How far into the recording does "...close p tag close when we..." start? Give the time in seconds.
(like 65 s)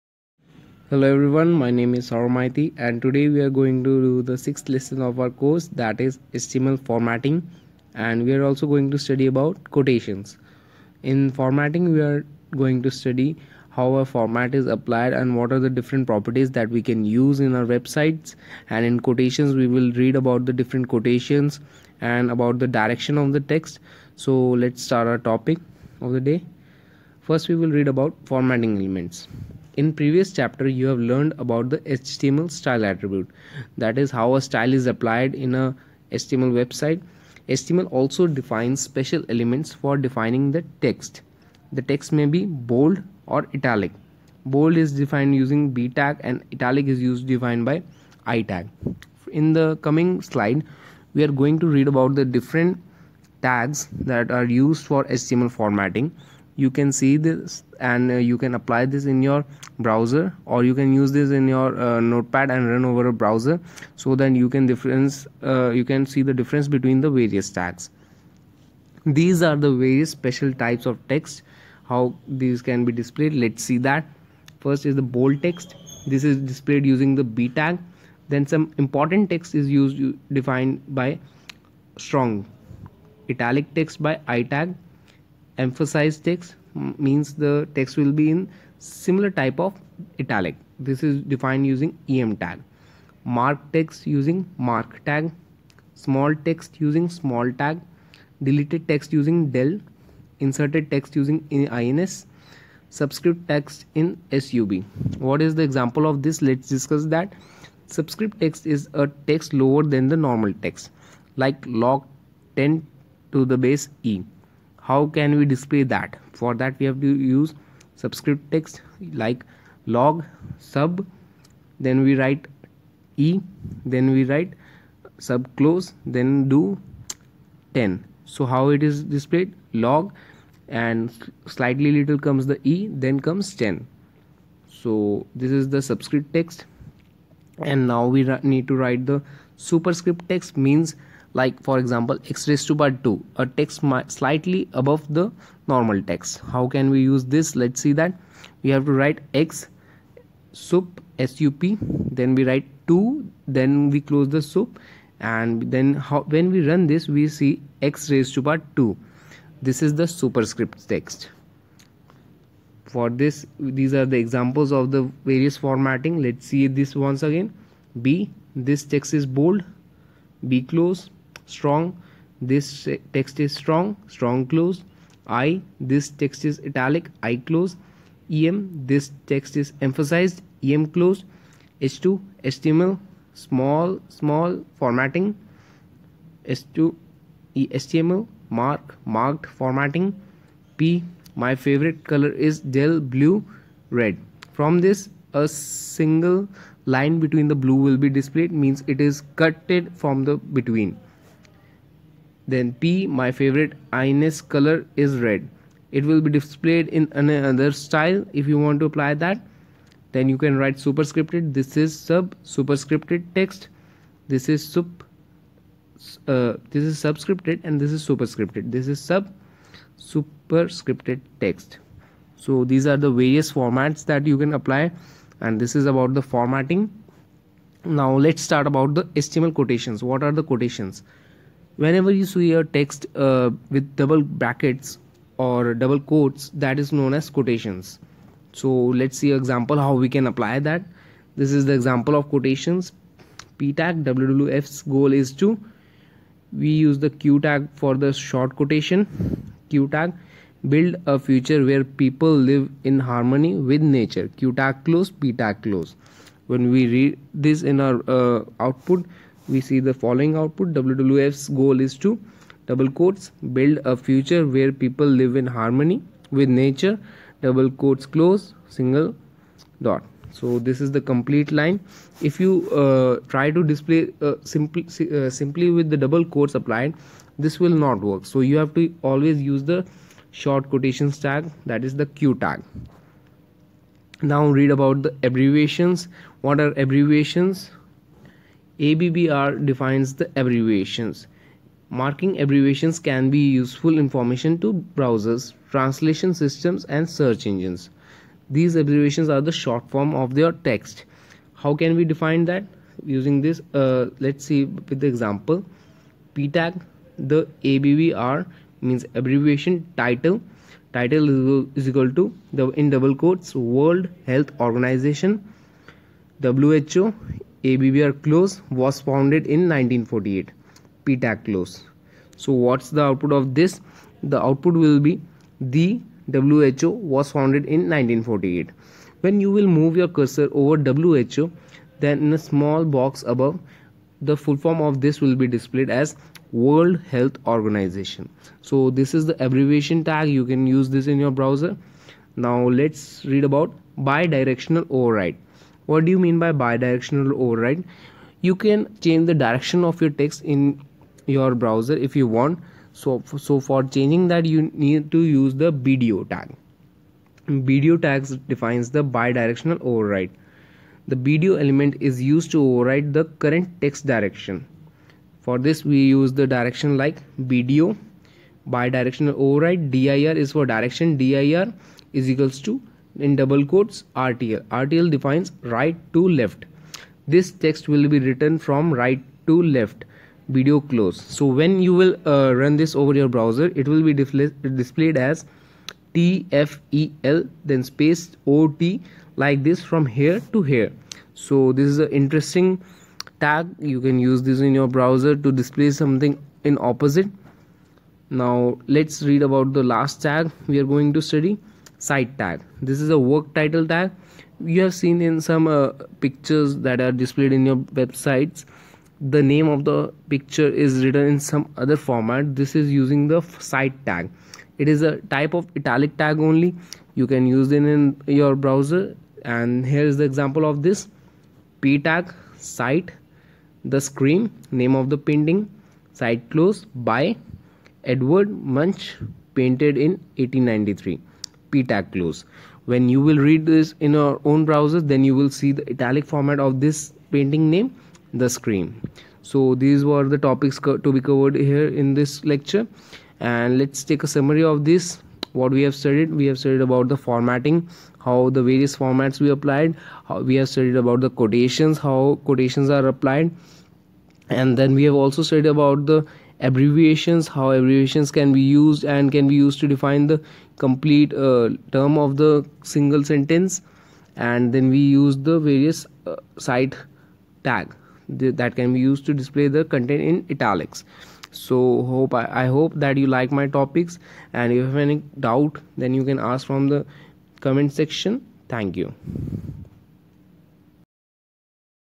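254 s.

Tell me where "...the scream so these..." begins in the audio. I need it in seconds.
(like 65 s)
438 s.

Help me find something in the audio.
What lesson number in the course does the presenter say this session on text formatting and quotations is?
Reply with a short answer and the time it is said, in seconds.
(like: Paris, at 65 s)
sixth, at 4 s.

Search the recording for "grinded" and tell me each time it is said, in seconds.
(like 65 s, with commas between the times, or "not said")
not said.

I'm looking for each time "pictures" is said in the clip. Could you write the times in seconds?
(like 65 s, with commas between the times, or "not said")
406 s, 410 s.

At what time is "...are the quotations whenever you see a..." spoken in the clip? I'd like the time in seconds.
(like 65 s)
230 s.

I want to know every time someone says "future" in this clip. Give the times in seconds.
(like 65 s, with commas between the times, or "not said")
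251 s, 263 s.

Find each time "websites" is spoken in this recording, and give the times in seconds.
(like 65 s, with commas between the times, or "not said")
17 s, 36 s, 407 s.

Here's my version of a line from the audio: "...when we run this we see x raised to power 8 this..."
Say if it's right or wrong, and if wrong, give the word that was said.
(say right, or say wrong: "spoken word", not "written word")
wrong: "2", not "8".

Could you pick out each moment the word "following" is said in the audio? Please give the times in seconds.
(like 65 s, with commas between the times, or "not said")
260 s.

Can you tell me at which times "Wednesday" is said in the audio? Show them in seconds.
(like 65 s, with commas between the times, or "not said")
not said.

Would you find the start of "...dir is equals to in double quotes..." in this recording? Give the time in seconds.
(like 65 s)
371 s.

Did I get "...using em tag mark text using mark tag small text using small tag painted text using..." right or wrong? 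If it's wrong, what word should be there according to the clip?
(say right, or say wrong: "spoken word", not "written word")
wrong: "deleted", not "painted".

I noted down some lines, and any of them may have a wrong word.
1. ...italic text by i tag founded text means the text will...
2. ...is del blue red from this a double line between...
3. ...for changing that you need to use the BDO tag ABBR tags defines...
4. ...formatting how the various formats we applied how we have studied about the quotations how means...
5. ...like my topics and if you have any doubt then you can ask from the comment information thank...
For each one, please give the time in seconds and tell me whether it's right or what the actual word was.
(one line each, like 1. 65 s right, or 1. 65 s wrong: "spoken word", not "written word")
1. 83 s wrong: "emphasized", not "founded"
2. 192 s wrong: "single", not "double"
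3. 353 s wrong: "BDO", not "ABBR"
4. 447 s wrong: "quotations", not "means"
5. 473 s wrong: "section", not "information".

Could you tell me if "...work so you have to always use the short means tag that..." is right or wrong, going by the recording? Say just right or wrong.
wrong.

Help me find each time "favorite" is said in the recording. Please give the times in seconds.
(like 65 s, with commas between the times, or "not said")
191 s, 203 s.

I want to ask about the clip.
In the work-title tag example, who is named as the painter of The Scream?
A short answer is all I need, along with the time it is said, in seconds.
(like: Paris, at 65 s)
Edward Munch, at 428 s.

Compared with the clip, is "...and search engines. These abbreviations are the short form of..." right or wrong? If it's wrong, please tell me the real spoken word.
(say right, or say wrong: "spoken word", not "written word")
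right.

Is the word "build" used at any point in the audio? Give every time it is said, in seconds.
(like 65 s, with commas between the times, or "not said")
250 s, 263 s.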